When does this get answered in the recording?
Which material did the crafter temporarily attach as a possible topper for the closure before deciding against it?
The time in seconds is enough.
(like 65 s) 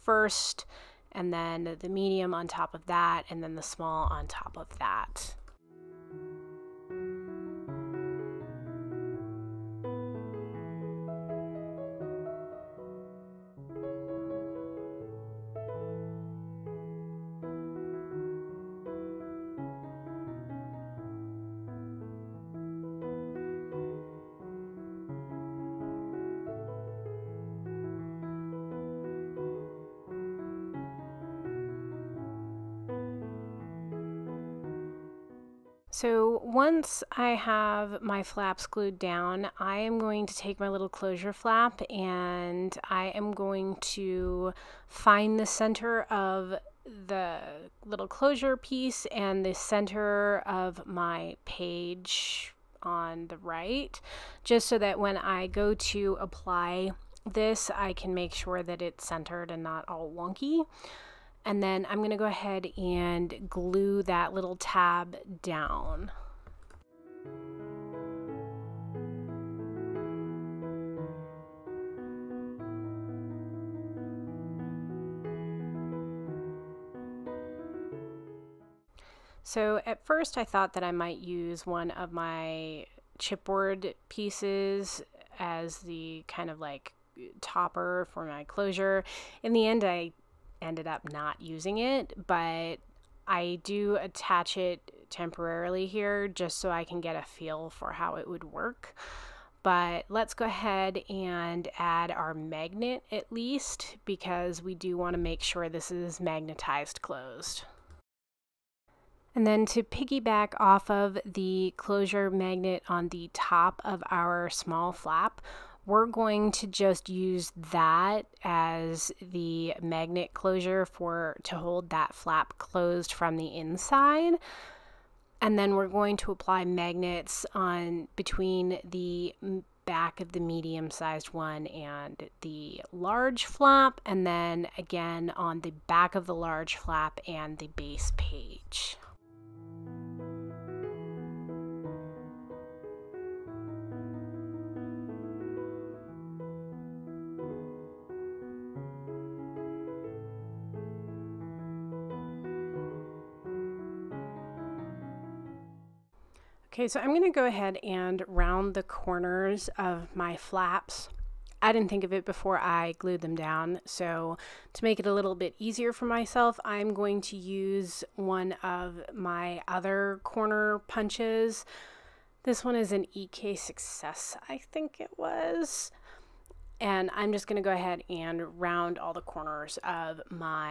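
83 s.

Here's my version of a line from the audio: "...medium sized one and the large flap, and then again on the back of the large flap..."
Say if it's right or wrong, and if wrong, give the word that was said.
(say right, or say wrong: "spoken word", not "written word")
right.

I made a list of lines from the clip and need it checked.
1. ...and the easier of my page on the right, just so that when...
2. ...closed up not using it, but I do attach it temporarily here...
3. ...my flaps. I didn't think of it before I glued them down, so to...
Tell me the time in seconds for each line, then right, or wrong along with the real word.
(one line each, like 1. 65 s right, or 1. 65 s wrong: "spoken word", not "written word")
1. 49 s wrong: "center", not "easier"
2. 90 s wrong: "ended", not "closed"
3. 160 s right.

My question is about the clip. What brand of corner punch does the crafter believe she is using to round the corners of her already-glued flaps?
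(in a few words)
EK Success.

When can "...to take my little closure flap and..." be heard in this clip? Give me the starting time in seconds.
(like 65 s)
40 s.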